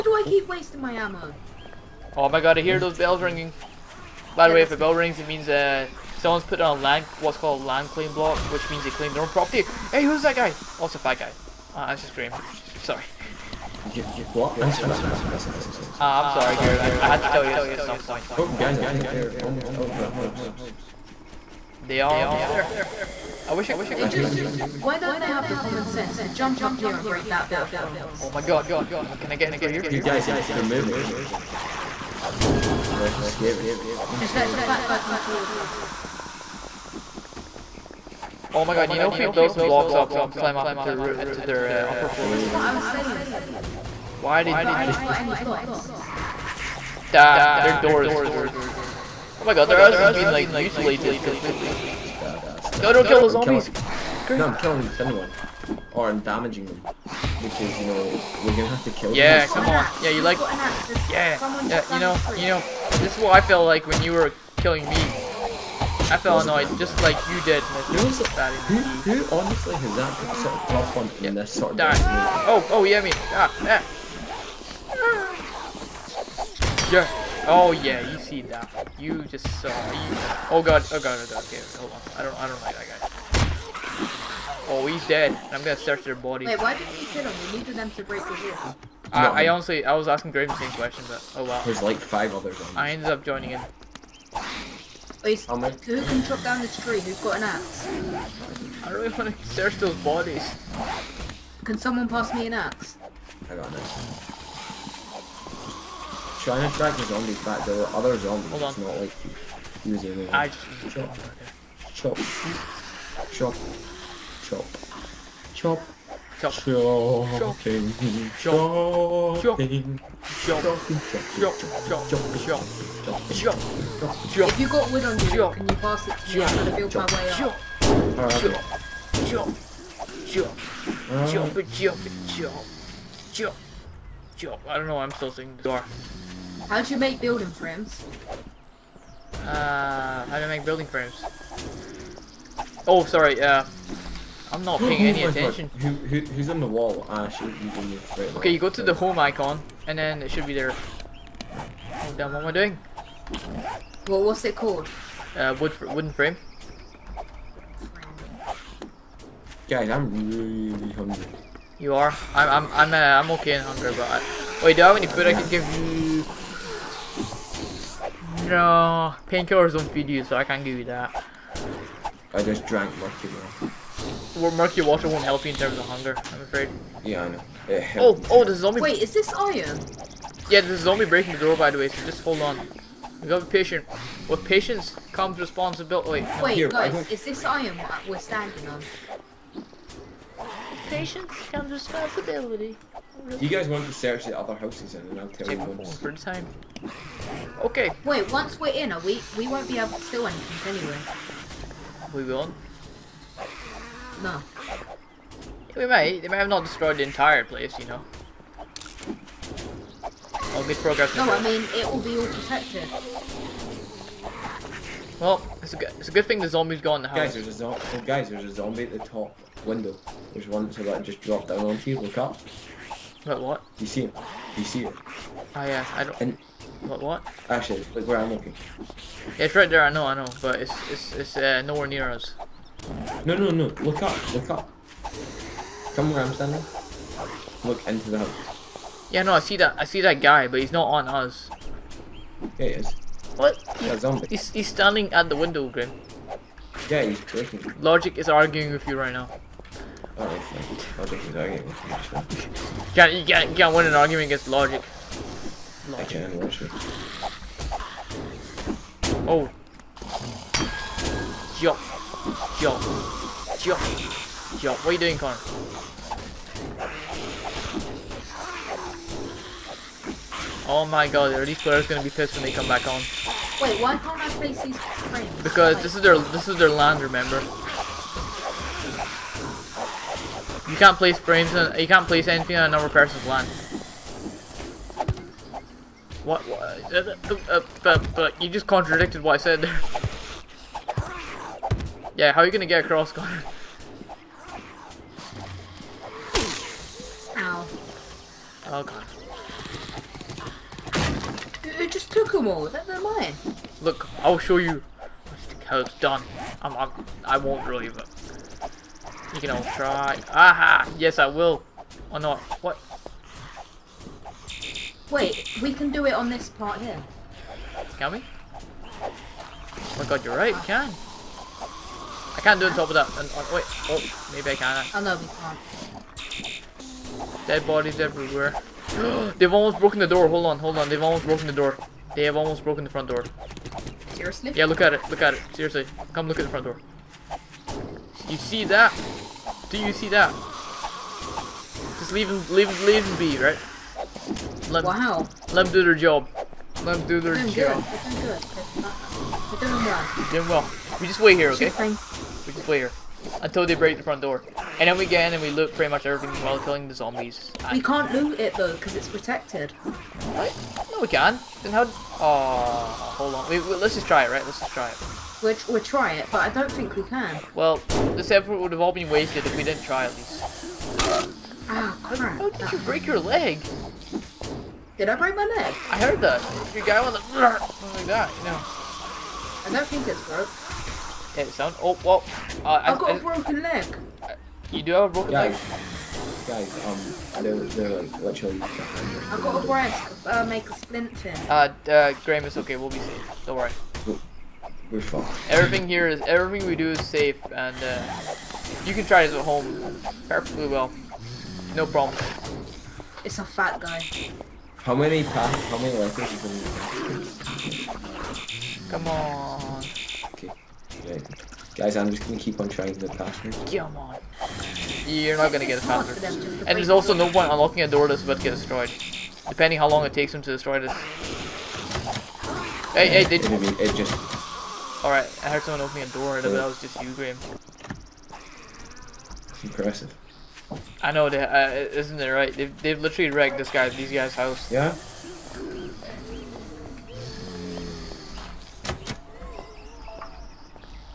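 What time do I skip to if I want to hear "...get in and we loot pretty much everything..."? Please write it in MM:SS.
05:55.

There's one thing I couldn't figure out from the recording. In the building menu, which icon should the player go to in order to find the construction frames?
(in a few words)
home icon.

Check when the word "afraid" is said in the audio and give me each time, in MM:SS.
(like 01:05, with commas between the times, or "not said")
02:56.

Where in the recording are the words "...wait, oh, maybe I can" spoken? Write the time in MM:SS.
05:23.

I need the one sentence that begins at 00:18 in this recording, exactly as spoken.
Oh, guys, I think they're almost out of the house.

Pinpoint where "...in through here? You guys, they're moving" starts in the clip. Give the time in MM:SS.
00:29.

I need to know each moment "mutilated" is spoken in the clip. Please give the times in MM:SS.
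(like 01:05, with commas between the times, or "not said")
00:50.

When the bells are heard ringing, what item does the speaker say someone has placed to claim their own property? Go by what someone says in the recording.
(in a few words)
land claim block.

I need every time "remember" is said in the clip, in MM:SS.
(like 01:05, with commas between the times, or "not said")
04:37.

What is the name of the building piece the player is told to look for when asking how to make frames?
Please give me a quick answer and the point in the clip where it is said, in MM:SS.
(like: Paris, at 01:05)
wooden frame, at 02:35.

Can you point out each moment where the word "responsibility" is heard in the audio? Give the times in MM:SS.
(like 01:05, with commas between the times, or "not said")
03:05, 03:11.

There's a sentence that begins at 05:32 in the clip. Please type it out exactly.
They have almost broken the front door.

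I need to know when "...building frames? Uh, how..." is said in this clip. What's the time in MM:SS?
02:17.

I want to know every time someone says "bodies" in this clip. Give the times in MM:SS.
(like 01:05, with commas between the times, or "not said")
01:39, 05:27.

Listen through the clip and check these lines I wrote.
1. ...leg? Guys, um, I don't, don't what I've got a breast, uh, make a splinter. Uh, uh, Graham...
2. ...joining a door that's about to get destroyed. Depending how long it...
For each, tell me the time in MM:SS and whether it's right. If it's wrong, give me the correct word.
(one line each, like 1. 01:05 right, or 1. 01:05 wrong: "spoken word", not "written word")
1. 06:25 right
2. 06:57 wrong: "unlocking", not "joining".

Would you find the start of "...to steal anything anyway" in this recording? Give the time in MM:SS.
03:19.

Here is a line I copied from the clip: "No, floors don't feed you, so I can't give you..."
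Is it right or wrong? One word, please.
wrong.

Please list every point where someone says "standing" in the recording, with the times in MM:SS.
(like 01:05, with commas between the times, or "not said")
03:08, 03:56, 04:04.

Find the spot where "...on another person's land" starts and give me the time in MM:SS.
04:42.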